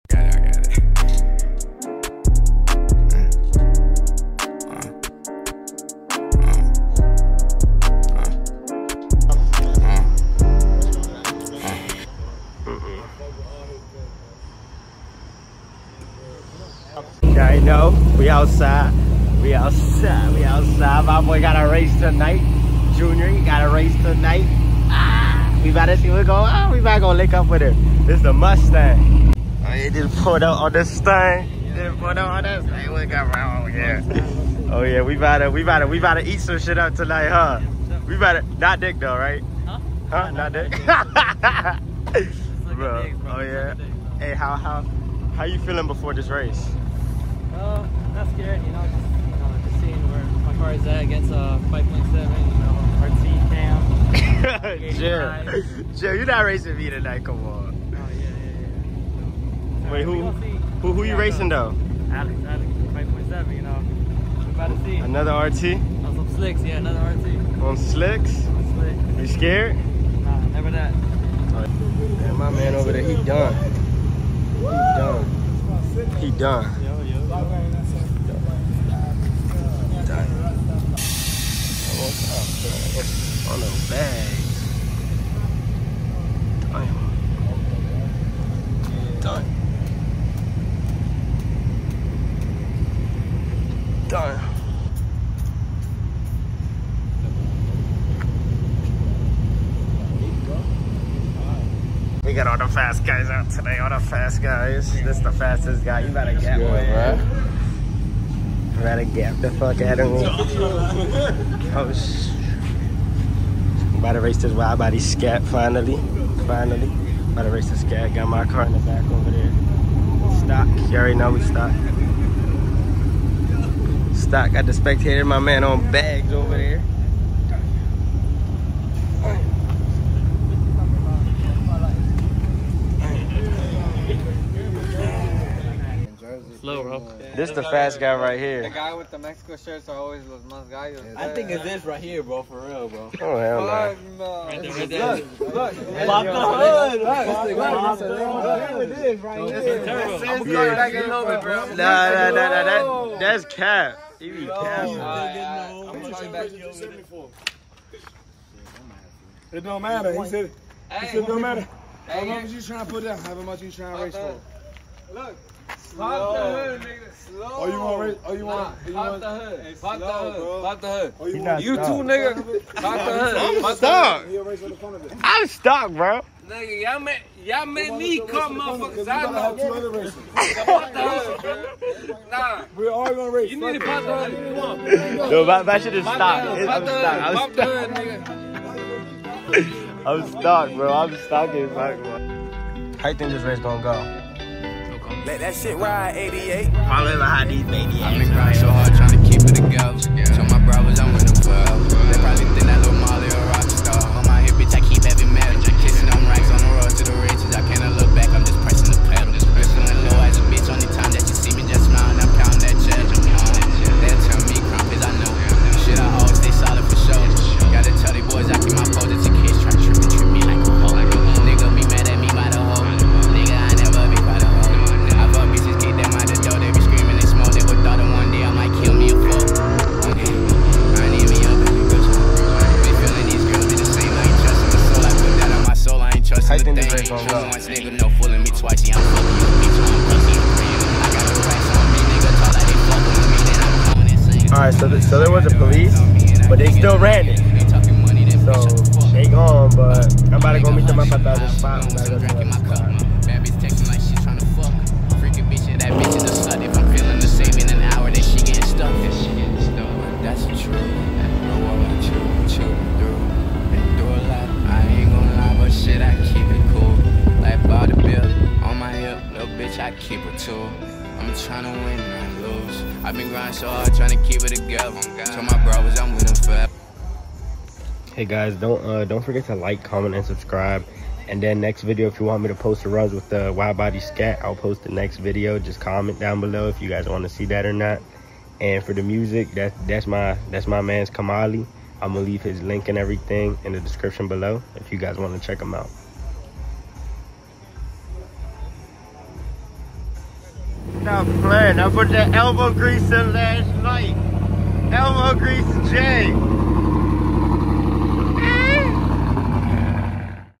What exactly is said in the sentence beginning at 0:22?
Junior, he got a race tonight.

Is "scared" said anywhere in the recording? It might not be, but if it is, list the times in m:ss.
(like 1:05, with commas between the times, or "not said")
0:48, 1:09.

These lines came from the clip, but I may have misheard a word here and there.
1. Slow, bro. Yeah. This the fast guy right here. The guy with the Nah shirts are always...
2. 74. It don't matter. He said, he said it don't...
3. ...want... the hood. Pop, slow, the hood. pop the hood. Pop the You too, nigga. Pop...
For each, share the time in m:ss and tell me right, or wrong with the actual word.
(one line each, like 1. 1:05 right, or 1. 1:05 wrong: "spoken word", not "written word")
1. 2:16 wrong: "Mexico", not "Nah"
2. 2:36 right
3. 2:49 right.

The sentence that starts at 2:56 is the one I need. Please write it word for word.
Nigga, y'all made, y'all made me come, motherfuckers.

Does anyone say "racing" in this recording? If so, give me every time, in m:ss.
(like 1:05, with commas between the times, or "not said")
0:56, 1:01.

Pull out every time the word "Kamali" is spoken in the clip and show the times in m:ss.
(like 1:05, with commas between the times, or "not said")
4:51.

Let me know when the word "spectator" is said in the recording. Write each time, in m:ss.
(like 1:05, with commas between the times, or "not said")
2:04.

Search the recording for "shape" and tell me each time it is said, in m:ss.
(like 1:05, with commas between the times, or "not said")
not said.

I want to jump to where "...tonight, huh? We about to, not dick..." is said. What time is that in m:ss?
0:36.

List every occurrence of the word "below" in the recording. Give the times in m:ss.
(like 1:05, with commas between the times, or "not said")
4:46, 4:54.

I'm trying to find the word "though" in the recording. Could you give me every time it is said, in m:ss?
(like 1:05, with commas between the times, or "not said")
0:38, 1:01.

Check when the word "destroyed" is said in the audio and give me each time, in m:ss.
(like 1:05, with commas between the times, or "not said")
not said.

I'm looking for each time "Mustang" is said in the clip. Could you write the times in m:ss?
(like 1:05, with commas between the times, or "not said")
0:28.